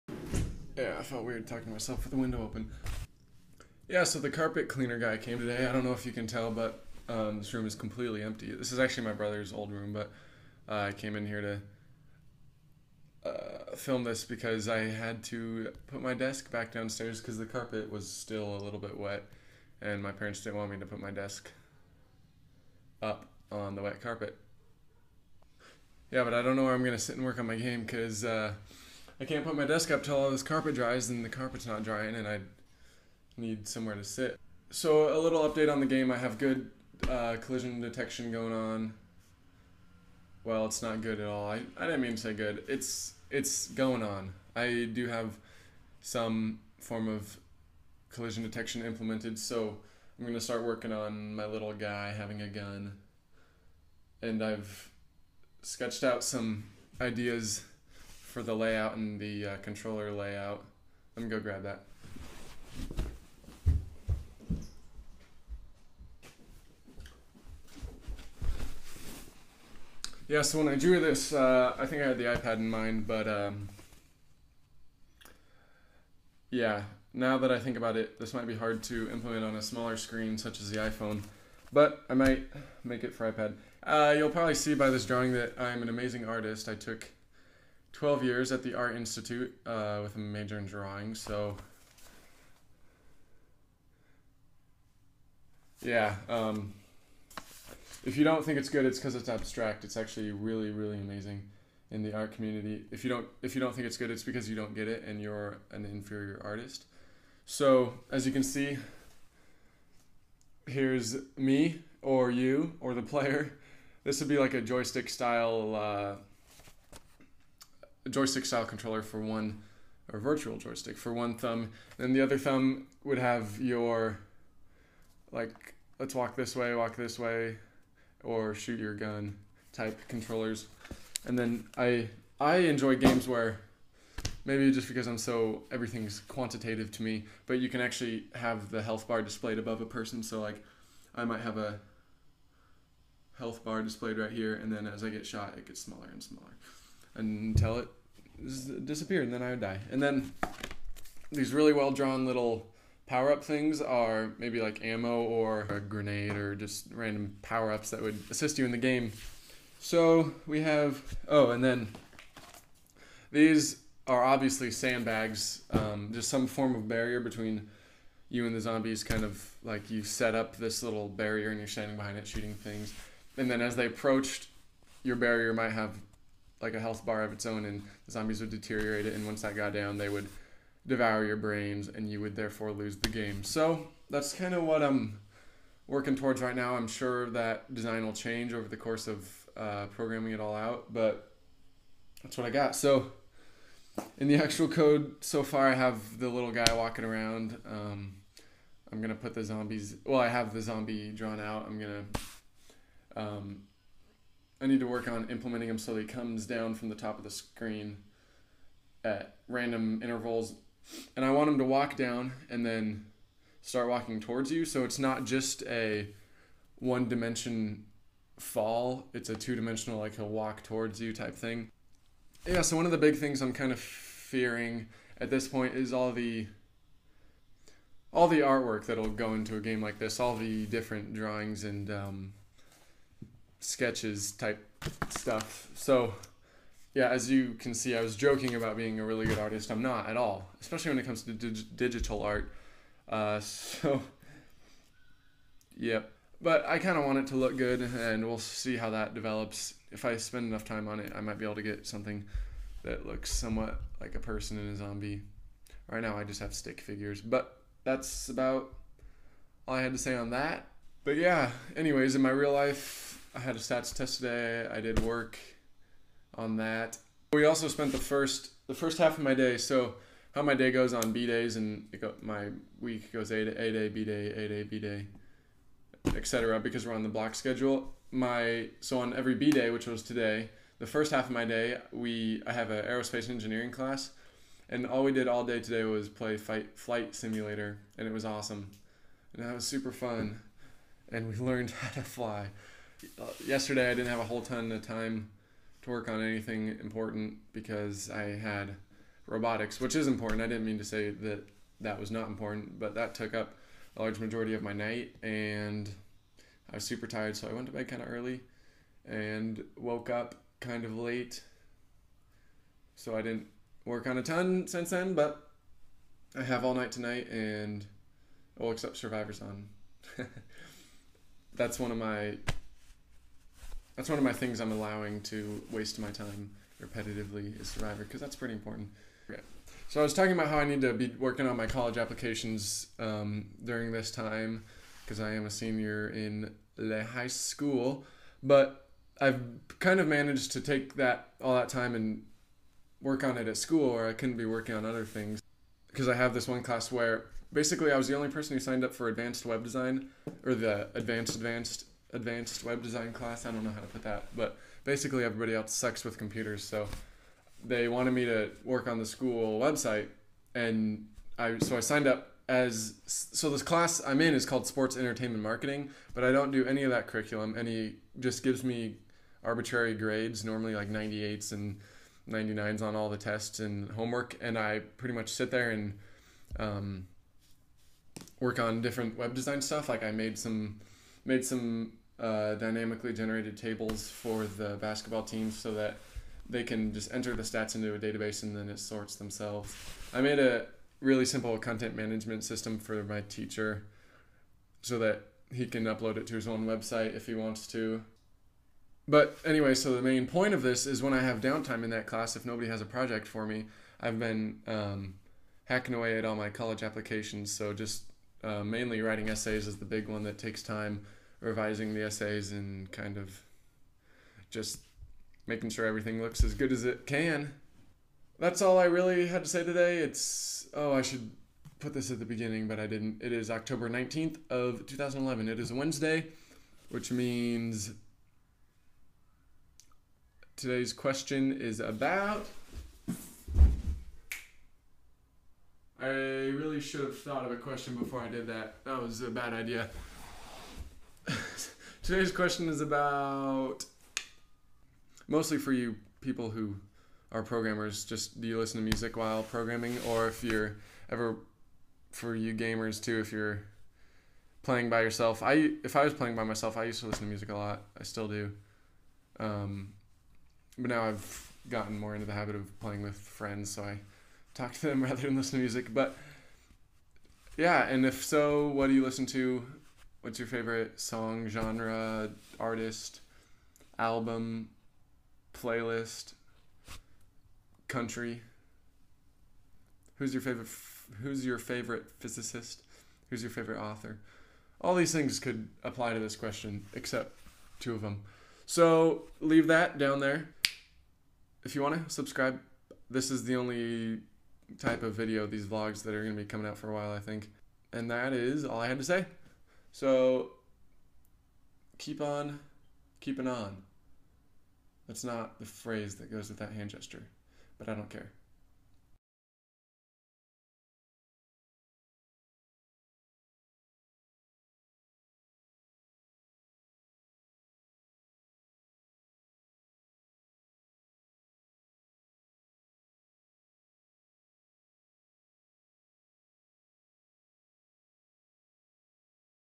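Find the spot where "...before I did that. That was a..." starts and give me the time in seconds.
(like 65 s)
437 s.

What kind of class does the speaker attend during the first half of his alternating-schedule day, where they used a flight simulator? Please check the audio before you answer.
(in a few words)
Aerospace engineering.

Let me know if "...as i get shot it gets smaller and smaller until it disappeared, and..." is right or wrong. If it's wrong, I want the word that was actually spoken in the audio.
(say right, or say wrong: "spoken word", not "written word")
right.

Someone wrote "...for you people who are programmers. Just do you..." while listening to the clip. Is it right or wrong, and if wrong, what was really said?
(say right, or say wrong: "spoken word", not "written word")
right.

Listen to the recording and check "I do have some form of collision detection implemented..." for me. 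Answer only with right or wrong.
right.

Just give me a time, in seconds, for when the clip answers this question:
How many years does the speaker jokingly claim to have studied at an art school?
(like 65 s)
87 s.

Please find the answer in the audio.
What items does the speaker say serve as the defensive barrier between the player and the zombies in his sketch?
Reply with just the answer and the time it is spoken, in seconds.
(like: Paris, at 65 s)
Sandbags, at 164 s.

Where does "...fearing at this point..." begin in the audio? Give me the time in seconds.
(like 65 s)
223 s.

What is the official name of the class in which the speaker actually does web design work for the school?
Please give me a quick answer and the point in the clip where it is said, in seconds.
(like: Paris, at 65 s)
Sports entertainment marketing, at 364 s.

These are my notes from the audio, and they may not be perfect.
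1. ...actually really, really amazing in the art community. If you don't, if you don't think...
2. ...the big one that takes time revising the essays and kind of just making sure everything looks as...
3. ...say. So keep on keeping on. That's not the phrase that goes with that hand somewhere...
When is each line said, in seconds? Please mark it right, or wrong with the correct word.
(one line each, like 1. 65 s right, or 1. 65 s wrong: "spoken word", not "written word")
1. 99 s right
2. 409 s right
3. 499 s wrong: "gesture", not "somewhere".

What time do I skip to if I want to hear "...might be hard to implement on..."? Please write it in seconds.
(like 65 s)
78 s.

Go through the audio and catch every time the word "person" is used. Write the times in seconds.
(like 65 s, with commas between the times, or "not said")
139 s, 254 s, 348 s.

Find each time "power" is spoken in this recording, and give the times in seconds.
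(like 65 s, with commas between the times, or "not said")
153 s, 157 s.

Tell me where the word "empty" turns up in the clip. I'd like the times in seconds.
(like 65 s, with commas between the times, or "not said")
8 s.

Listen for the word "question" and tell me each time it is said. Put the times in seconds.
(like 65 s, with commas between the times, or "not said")
430 s, 437 s, 442 s, 486 s.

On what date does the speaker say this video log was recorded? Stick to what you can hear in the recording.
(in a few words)
October 19th, 2011.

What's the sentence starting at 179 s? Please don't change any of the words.
And once that got down, they would devour your brains, and you would therefore lose the game.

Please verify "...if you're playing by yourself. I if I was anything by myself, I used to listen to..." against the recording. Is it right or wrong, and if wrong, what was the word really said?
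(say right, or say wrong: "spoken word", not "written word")
wrong: "playing", not "anything".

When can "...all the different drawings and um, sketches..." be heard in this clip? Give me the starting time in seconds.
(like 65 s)
230 s.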